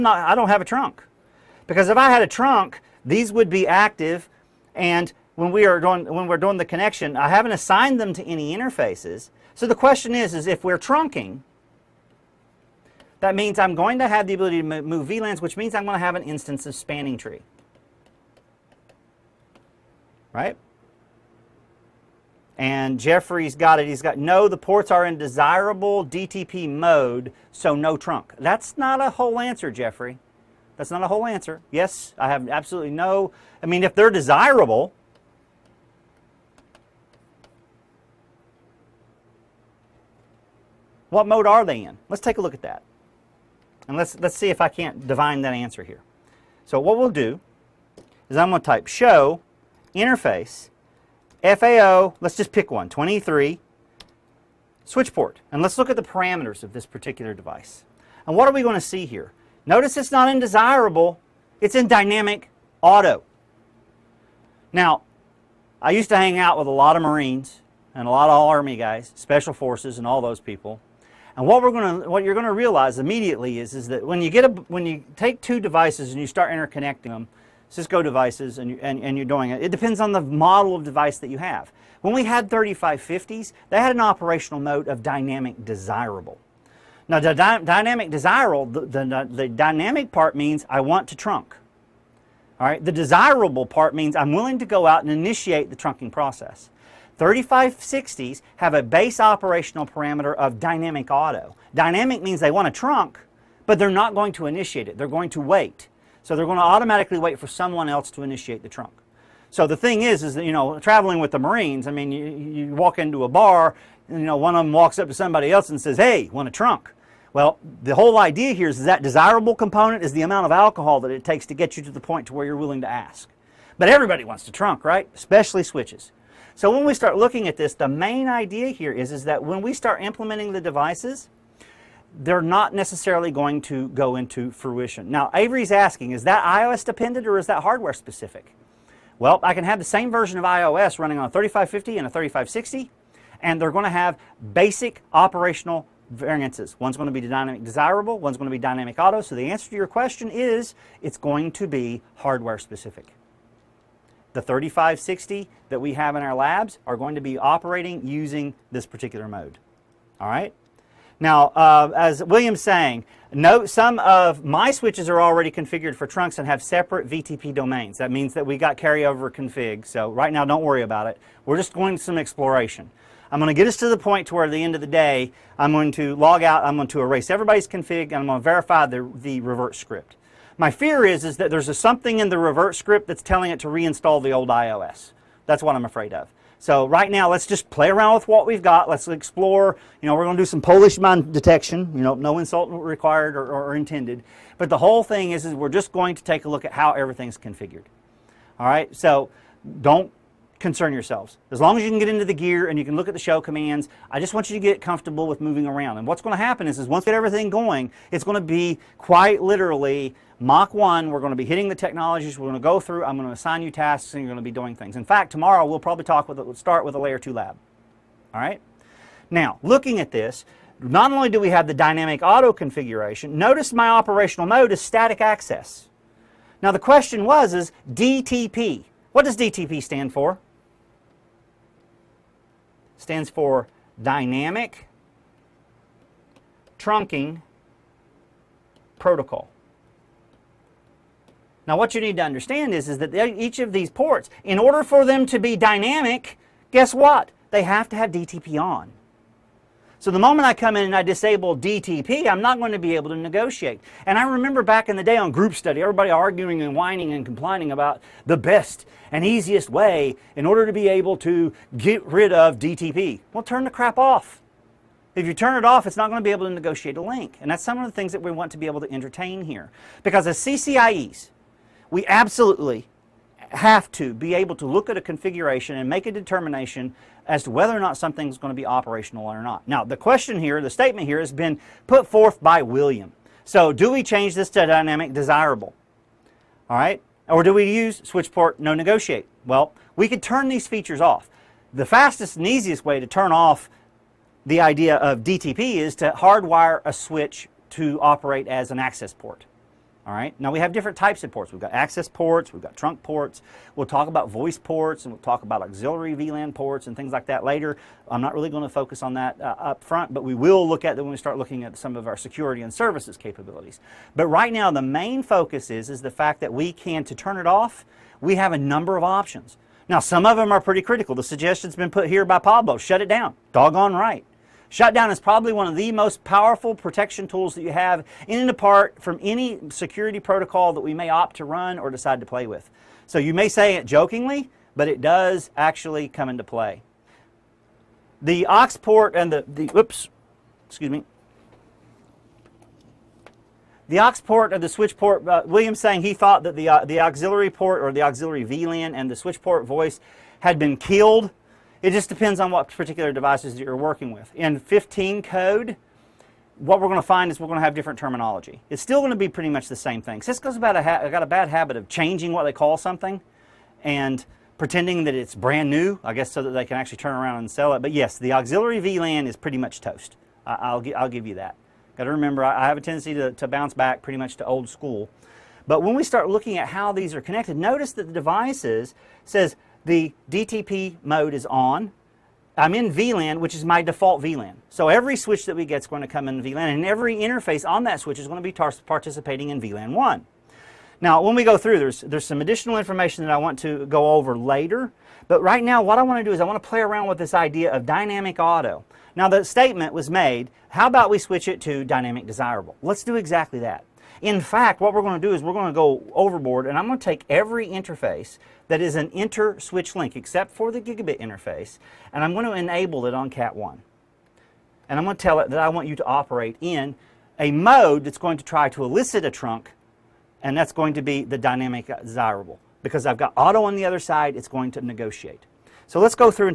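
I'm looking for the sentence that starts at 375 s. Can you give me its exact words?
But when we start looking at how these are connected, notice that the devices says the DTP mode is on.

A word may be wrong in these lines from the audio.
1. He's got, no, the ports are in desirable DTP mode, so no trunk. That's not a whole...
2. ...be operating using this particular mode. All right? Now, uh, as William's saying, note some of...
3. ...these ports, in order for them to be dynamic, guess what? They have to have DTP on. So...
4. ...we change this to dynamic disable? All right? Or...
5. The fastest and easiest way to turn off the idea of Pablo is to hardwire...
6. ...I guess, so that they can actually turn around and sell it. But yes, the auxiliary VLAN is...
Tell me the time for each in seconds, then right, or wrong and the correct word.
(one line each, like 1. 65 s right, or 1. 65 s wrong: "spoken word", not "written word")
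1. 23 s right
2. 157 s right
3. 243 s right
4. 283 s wrong: "desirable", not "disable"
5. 291 s wrong: "DTP", not "Pablo"
6. 366 s right.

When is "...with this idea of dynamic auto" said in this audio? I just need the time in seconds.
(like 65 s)
397 s.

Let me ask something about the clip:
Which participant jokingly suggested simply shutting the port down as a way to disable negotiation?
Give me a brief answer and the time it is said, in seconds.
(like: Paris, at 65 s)
Pablo, at 322 s.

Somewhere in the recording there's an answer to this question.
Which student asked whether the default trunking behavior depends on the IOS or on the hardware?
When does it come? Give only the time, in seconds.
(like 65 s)
135 s.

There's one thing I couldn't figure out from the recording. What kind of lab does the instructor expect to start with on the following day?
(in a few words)
A Layer 2 lab.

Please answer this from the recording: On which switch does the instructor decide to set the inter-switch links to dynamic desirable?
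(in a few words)
Cat 1.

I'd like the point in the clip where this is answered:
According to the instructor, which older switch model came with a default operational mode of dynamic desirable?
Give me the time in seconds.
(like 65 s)
82 s.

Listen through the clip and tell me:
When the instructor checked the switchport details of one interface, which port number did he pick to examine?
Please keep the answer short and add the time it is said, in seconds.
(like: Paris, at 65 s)
23, at 52 s.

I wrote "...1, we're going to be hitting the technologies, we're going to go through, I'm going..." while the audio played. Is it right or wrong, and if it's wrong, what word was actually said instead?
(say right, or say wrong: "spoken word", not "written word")
right.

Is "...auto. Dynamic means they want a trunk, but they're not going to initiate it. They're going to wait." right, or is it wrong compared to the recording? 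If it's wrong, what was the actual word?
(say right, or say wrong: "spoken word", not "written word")
right.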